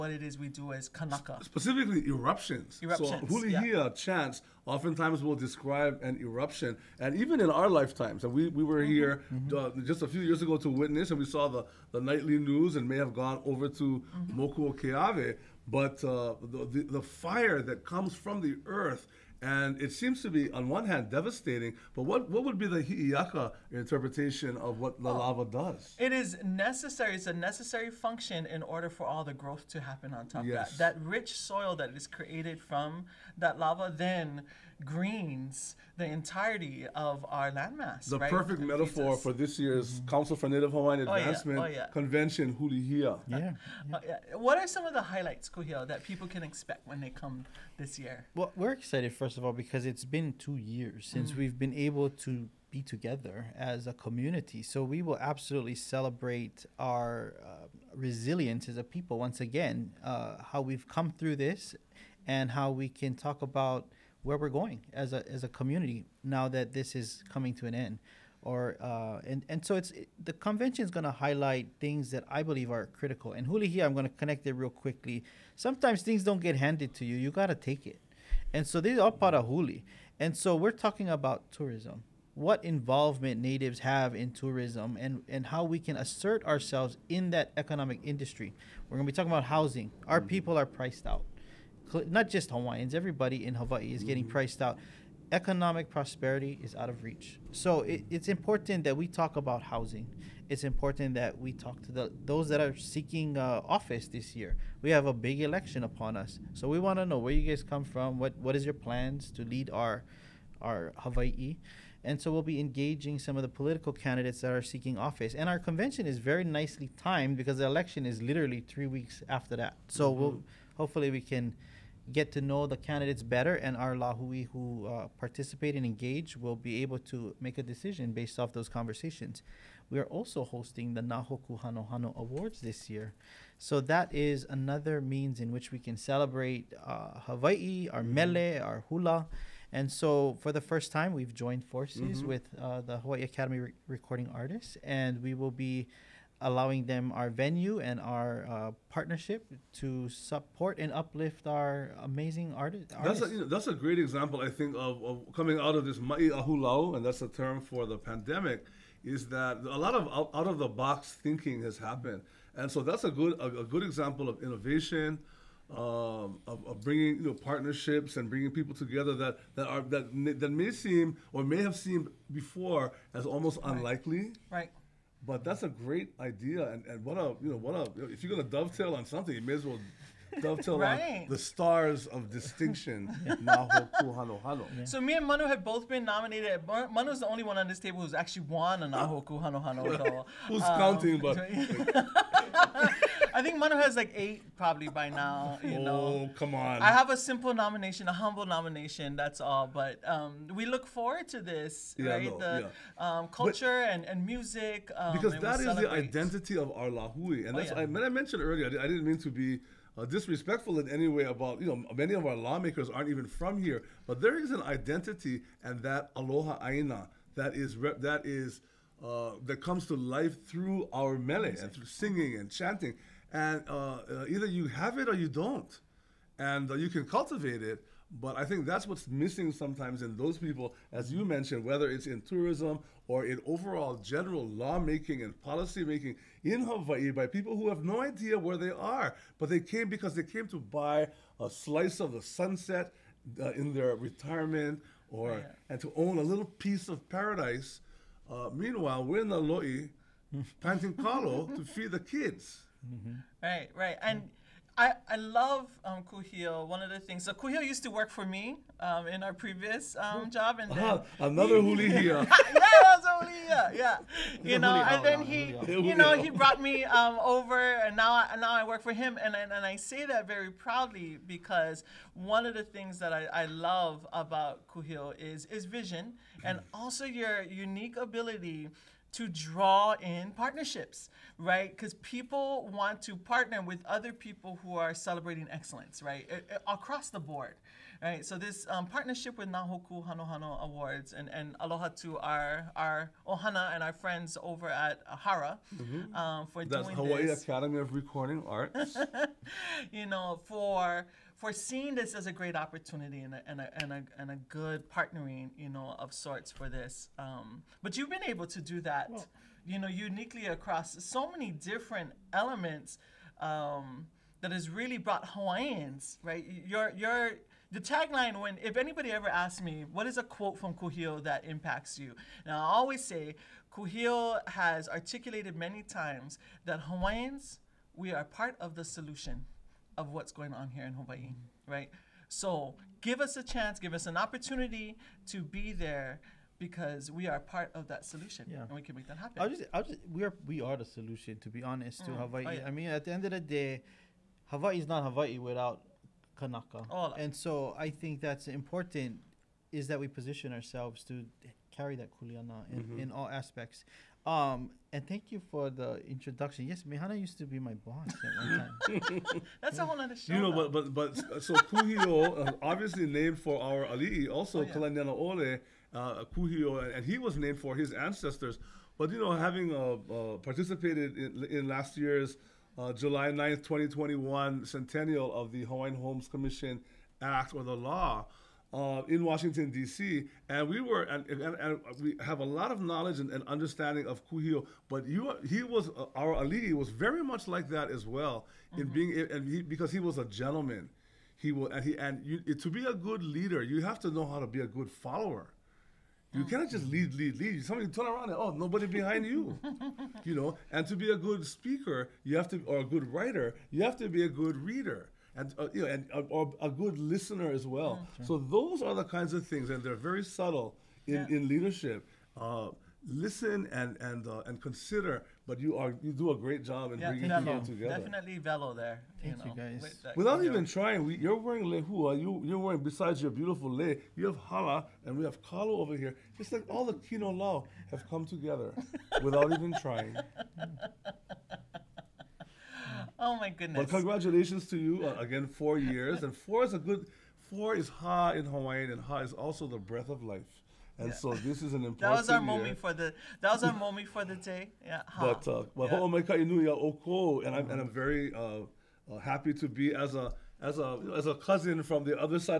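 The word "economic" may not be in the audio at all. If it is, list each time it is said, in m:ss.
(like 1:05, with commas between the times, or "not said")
1:27, 1:35.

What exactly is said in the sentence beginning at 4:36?
also your unique ability to draw in partnerships, right?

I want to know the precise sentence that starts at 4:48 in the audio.
So this um, partnership with Nahoku Hanohano Awards and, and aloha to our, our Ohana and our friends over at Ahara mm-hmm.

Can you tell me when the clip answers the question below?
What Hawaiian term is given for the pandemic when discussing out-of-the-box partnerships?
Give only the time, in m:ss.
2:35.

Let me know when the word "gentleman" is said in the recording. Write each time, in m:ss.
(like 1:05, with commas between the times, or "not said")
6:30.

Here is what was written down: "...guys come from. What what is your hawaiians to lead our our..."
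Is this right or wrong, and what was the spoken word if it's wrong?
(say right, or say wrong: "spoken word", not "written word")
wrong: "plans", not "hawaiians".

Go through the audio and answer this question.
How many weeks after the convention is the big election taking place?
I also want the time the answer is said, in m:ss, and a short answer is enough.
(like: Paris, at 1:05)
3 weeks, at 1:58.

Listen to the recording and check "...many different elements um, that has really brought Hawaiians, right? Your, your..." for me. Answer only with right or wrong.
right.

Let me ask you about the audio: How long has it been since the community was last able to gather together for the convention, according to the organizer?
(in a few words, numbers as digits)
2 years.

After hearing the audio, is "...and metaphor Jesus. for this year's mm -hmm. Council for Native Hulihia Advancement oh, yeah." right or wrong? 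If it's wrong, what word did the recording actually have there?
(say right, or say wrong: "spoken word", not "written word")
wrong: "Hawaiian", not "Hulihia".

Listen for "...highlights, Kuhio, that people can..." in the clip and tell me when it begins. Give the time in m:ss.
0:45.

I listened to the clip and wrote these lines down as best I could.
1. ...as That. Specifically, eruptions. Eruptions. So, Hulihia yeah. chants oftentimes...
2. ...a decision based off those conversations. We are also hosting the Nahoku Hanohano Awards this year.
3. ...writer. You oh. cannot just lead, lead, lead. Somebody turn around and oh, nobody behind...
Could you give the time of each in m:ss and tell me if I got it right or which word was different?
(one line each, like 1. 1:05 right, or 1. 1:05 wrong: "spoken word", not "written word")
1. 0:00 wrong: "Kanaka", not "That"
2. 2:07 right
3. 6:34 wrong: "follower", not "writer".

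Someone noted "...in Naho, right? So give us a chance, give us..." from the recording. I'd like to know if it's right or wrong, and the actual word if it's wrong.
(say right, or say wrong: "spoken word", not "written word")
wrong: "Hawaii", not "Naho".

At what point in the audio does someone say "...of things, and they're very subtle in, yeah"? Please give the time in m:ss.
6:49.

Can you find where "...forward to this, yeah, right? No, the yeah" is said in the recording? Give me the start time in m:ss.
3:20.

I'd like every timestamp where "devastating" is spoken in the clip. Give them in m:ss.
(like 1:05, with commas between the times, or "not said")
0:21.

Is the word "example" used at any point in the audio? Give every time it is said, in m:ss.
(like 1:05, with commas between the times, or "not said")
2:33, 2:43.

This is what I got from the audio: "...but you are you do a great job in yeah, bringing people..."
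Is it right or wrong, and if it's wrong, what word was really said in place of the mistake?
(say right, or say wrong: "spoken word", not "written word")
right.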